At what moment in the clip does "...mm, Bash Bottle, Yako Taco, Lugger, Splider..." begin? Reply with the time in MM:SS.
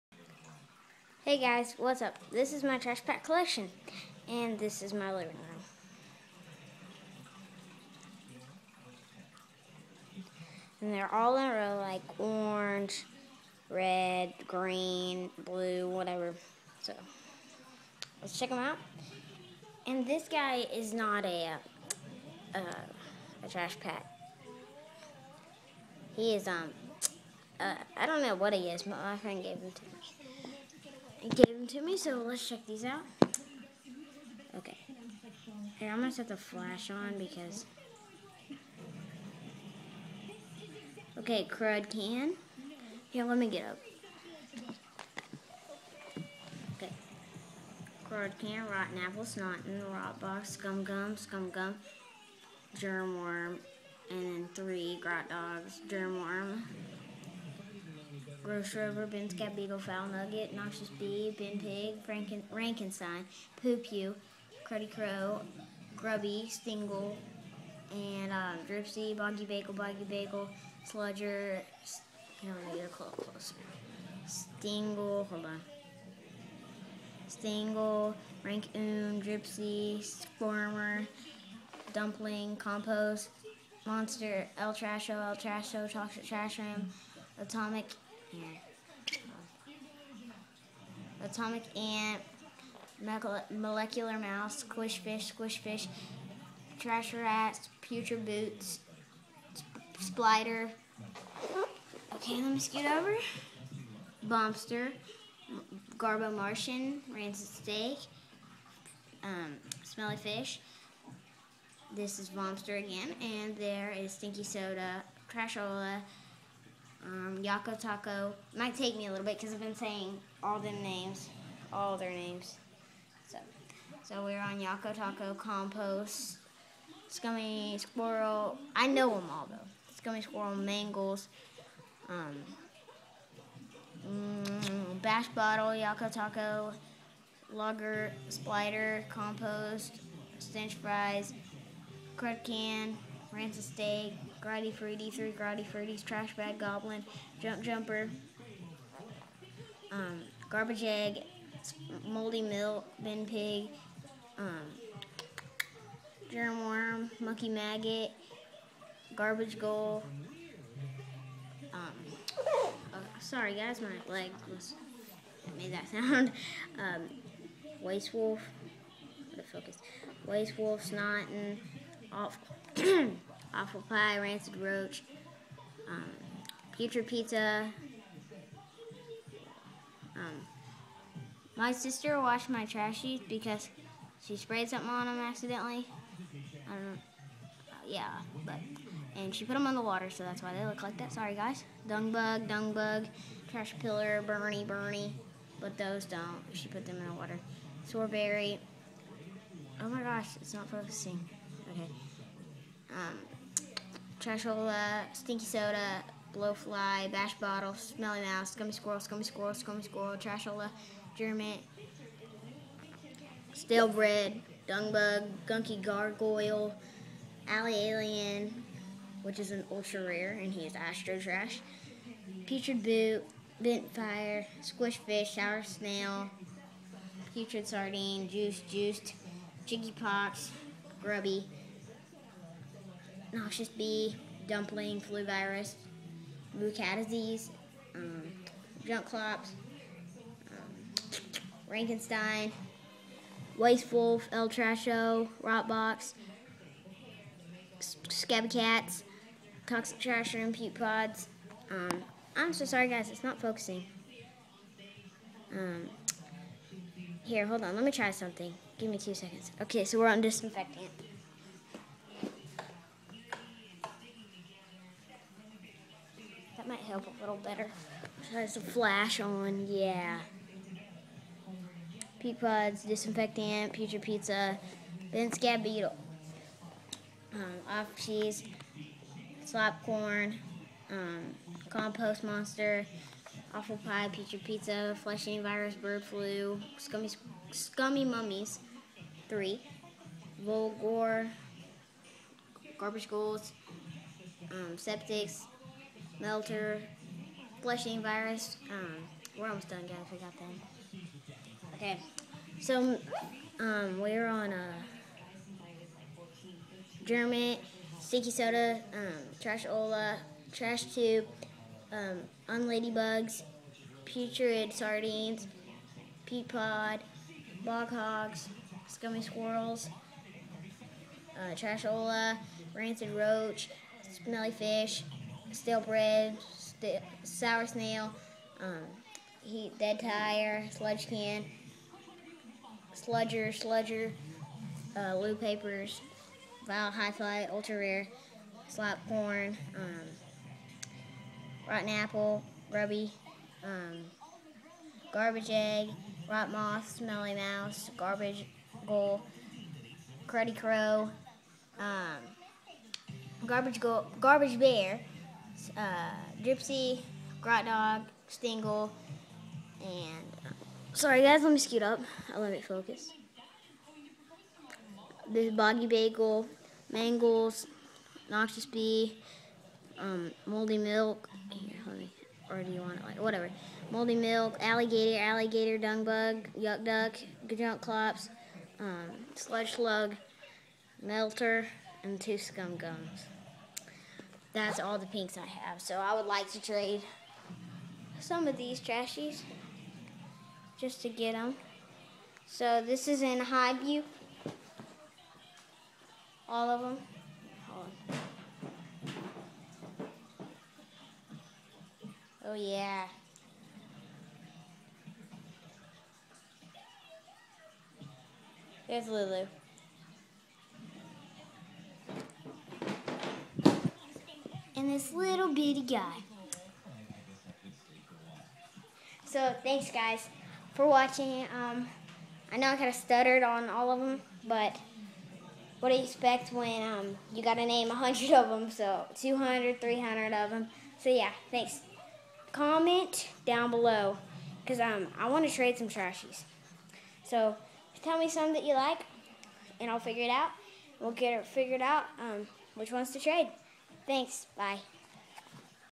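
02:14.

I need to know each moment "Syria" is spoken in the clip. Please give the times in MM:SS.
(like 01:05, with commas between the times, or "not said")
not said.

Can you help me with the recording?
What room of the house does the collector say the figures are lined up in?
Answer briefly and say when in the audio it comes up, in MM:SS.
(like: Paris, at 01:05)
living room, at 00:05.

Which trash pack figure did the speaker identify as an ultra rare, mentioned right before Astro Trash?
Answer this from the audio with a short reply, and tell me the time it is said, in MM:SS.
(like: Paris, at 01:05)
Alley Alien, at 03:37.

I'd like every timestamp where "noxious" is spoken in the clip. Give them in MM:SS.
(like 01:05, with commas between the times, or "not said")
01:00, 03:53, 06:08.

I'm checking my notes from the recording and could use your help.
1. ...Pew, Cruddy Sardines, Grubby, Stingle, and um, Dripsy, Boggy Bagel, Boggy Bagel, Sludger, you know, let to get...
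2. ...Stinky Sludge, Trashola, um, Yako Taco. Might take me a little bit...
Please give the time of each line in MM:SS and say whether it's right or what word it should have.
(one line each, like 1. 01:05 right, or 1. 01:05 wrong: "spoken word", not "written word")
1. 01:03 wrong: "Crow", not "Sardines"
2. 01:54 wrong: "Soda", not "Sludge".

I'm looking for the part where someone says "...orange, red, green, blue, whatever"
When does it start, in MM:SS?
00:12.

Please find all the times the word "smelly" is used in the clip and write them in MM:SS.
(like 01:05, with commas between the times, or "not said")
01:49, 03:27, 05:24, 05:46.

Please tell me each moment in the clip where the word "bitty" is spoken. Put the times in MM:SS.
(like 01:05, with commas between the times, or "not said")
06:55.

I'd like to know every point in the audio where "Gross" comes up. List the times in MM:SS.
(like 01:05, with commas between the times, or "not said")
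00:58.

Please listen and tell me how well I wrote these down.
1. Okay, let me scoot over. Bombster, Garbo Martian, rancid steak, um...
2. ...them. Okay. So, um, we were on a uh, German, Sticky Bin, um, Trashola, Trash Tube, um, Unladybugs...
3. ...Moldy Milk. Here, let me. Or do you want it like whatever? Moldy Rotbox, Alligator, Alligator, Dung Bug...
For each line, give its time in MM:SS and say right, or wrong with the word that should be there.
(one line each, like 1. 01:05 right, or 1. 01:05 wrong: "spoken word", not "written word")
1. 01:42 right
2. 05:00 wrong: "Soda", not "Bin"
3. 06:10 wrong: "Milk", not "Rotbox".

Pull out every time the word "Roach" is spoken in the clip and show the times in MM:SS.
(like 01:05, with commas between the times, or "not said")
02:54, 05:23.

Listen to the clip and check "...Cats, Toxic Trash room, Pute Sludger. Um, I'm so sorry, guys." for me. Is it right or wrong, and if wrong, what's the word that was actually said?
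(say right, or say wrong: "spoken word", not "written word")
wrong: "Pods", not "Sludger".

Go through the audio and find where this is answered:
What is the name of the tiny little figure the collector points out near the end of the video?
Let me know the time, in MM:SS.
06:49.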